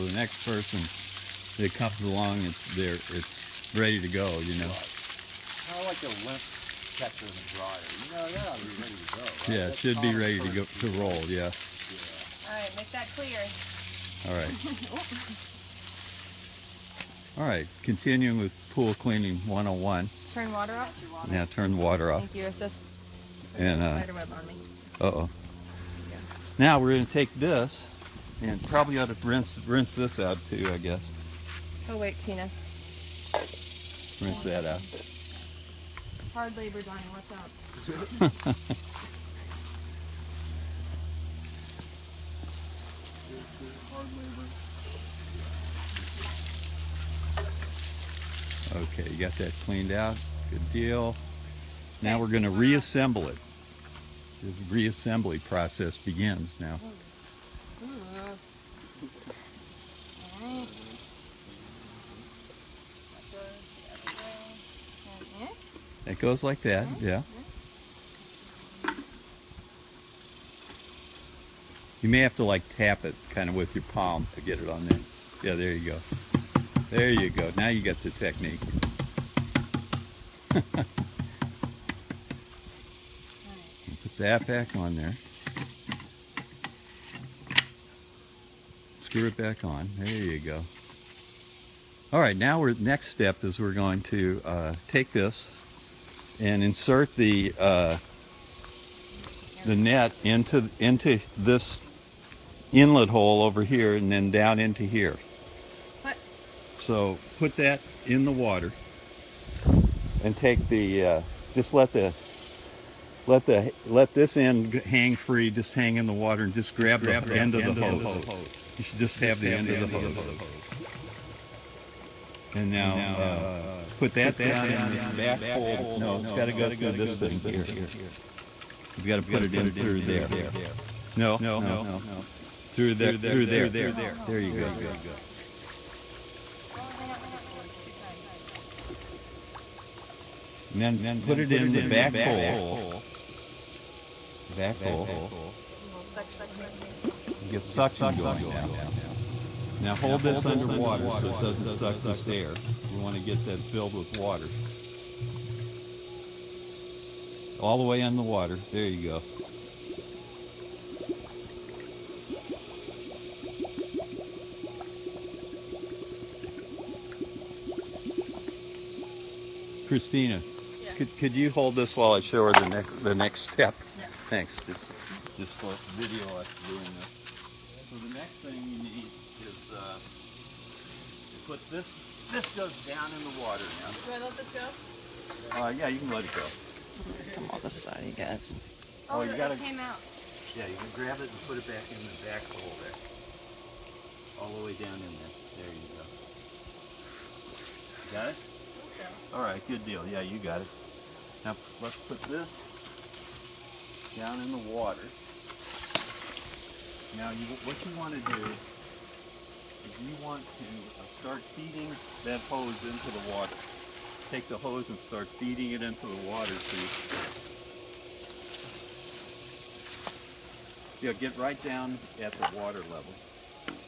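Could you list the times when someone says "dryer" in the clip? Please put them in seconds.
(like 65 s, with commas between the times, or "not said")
7 s.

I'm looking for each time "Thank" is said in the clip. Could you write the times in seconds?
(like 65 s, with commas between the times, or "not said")
22 s, 174 s.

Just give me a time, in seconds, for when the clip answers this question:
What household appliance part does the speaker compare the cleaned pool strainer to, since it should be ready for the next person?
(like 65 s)
6 s.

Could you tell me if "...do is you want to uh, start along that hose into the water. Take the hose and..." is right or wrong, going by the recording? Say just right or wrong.
wrong.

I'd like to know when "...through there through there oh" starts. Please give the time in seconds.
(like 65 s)
131 s.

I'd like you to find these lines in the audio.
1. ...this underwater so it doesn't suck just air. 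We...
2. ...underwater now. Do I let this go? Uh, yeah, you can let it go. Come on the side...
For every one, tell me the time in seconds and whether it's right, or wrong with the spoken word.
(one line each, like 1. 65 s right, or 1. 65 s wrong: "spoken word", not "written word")
1. 150 s right
2. 183 s wrong: "water", not "underwater".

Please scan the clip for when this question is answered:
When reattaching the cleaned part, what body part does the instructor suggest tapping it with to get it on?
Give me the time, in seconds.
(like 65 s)
73 s.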